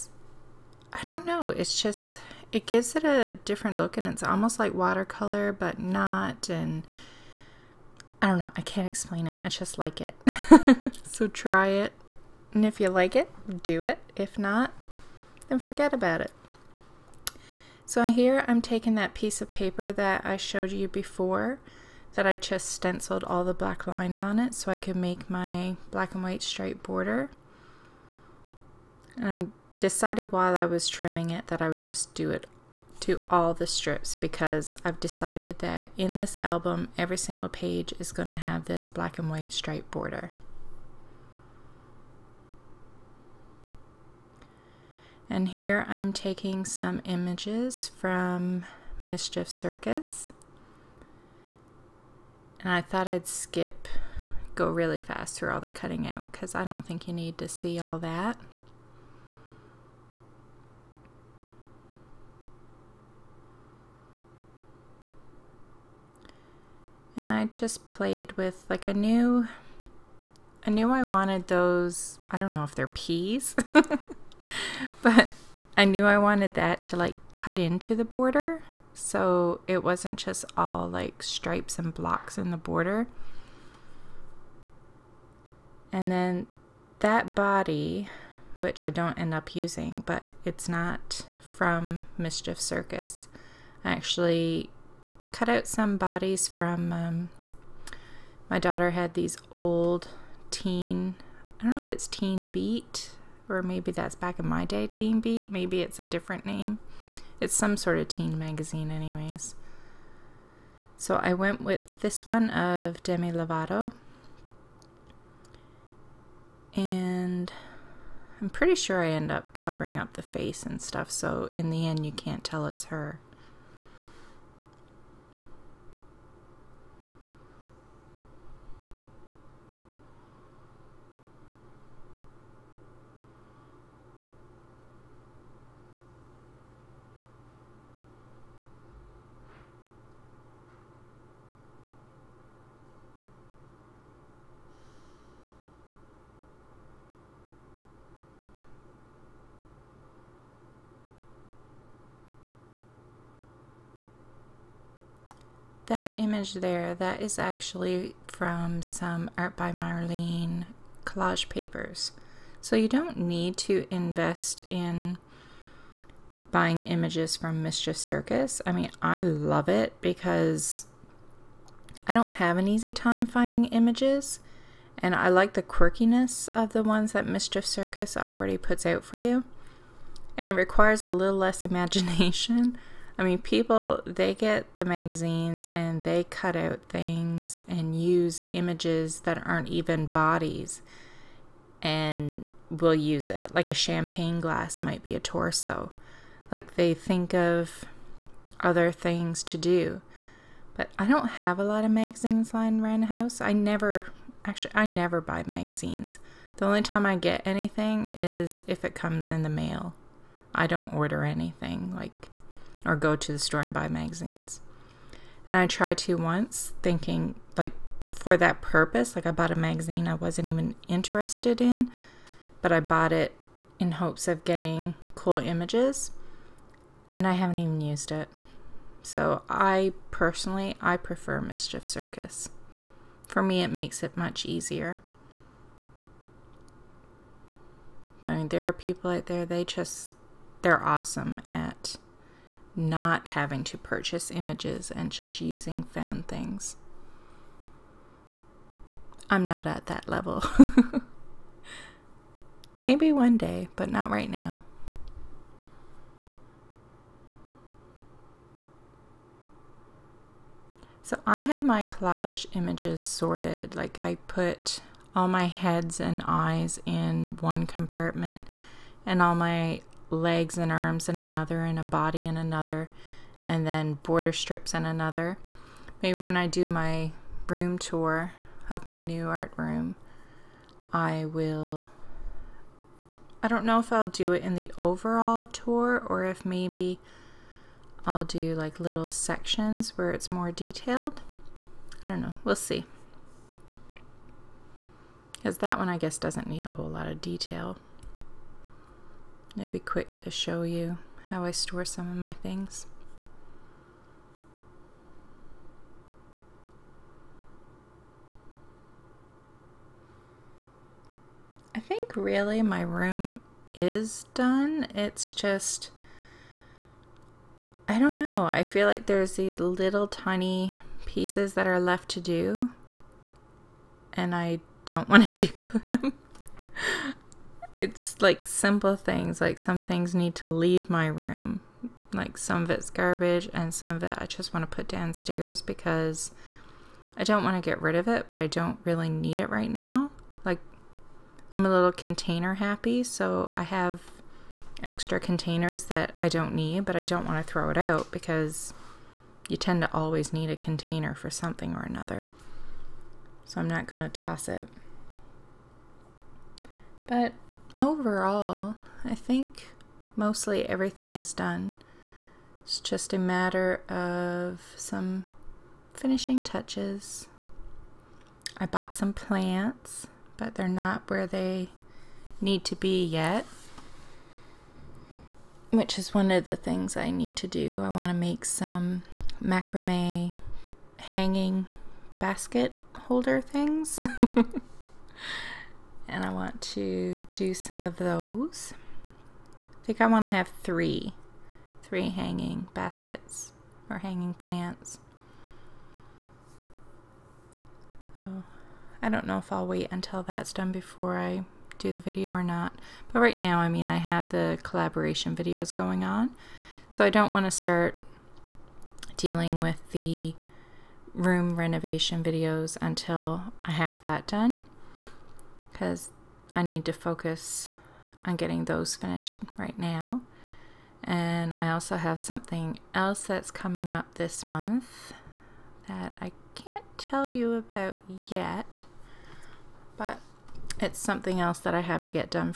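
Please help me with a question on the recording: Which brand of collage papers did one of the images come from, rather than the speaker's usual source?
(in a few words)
Art by Marlene.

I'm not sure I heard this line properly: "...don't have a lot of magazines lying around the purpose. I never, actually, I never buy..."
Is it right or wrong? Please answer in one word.
wrong.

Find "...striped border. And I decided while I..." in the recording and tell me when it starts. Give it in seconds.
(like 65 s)
26 s.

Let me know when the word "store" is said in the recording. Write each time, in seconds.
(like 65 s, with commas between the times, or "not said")
213 s, 301 s.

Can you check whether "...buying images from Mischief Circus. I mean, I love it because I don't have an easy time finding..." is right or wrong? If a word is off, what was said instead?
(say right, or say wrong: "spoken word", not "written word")
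right.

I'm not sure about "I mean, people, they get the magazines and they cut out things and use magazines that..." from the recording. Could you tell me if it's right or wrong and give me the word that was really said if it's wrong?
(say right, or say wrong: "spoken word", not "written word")
wrong: "images", not "magazines".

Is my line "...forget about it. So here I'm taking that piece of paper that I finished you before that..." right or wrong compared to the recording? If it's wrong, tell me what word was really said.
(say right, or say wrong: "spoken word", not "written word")
wrong: "showed", not "finished".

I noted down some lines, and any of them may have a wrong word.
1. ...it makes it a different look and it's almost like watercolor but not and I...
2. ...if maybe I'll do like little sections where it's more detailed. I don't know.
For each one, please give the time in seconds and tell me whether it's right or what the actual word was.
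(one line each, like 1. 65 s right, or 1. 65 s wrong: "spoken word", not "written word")
1. 2 s wrong: "gives", not "makes"
2. 286 s right.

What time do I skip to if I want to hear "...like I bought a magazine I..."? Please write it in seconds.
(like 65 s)
219 s.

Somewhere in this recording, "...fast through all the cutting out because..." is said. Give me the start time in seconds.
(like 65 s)
54 s.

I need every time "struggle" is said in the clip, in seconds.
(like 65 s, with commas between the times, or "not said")
not said.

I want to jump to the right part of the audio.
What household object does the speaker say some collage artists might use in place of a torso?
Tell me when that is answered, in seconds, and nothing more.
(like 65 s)
193 s.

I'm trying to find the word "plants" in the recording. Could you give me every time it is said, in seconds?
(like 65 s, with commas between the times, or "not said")
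369 s, 394 s.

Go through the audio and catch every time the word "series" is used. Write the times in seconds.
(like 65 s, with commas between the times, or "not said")
not said.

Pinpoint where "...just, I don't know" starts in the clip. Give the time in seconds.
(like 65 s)
315 s.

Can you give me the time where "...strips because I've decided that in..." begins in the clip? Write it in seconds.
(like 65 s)
33 s.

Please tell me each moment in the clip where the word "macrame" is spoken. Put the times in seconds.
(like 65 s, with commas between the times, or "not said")
379 s.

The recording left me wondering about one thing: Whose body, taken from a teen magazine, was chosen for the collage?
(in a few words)
Demi Lovato.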